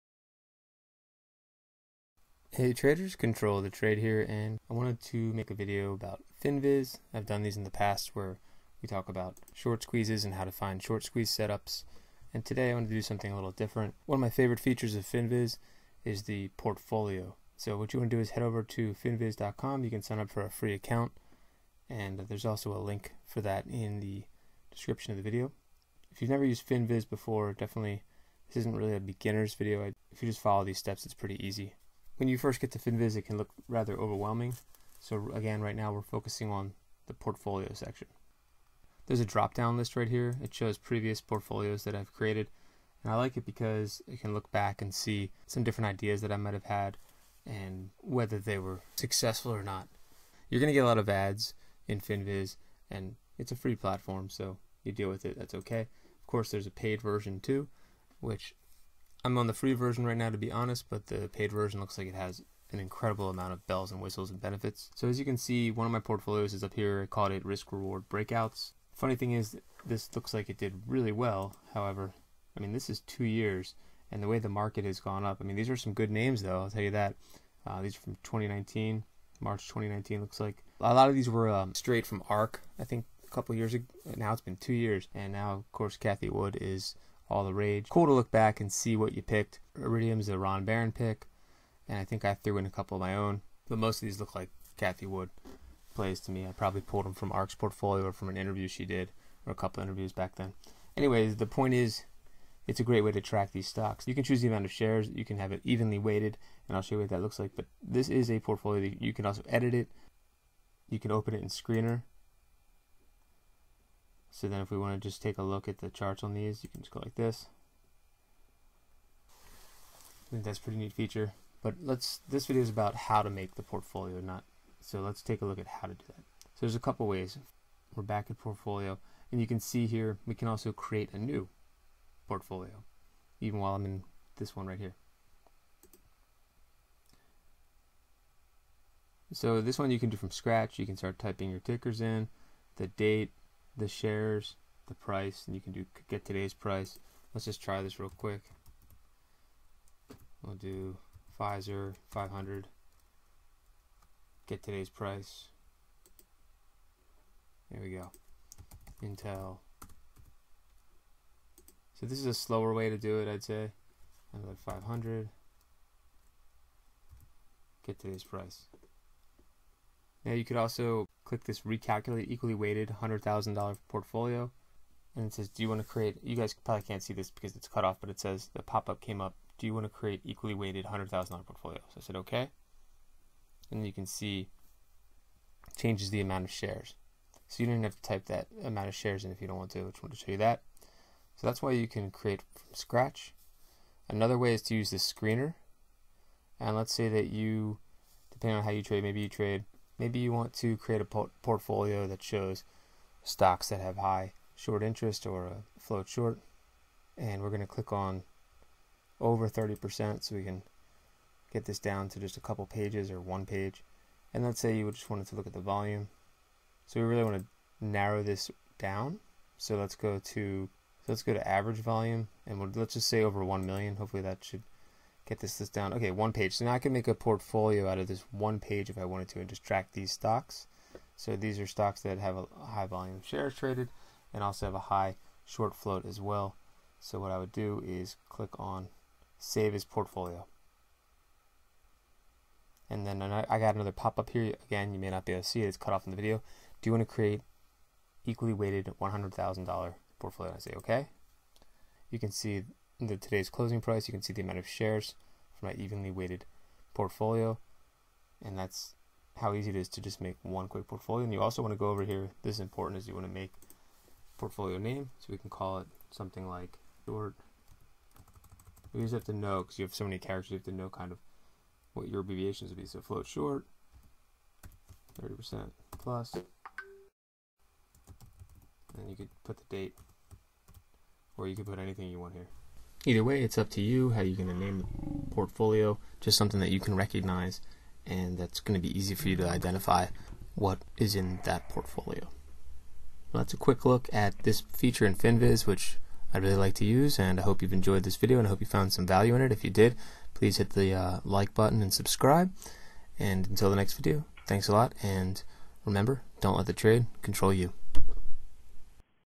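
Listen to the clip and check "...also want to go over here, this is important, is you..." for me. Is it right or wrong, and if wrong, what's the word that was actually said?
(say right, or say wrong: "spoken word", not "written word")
right.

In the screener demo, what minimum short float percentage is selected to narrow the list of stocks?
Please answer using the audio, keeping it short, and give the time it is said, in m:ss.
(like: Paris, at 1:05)
30%, at 3:29.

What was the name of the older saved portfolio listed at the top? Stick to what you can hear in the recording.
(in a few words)
Risk reward breakouts.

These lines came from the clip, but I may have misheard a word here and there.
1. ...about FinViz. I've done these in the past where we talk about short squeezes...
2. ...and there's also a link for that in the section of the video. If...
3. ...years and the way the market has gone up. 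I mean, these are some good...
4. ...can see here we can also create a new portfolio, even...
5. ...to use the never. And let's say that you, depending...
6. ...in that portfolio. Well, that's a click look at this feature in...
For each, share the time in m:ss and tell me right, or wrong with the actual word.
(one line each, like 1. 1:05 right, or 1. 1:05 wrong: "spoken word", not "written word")
1. 0:05 right
2. 0:21 wrong: "description", not "section"
3. 1:13 right
4. 2:09 right
5. 3:14 wrong: "screener", not "never"
6. 4:51 wrong: "quick", not "click".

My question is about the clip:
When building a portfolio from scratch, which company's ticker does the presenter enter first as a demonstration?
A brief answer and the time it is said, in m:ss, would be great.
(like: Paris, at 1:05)
Pfizer, at 2:31.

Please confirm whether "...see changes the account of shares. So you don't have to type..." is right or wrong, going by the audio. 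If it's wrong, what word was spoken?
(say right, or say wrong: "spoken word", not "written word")
wrong: "amount", not "account".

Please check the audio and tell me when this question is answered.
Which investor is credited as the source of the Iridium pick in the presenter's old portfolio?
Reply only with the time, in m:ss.
1:30.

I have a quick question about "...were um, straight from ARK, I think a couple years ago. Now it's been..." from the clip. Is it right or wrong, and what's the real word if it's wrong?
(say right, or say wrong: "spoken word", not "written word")
right.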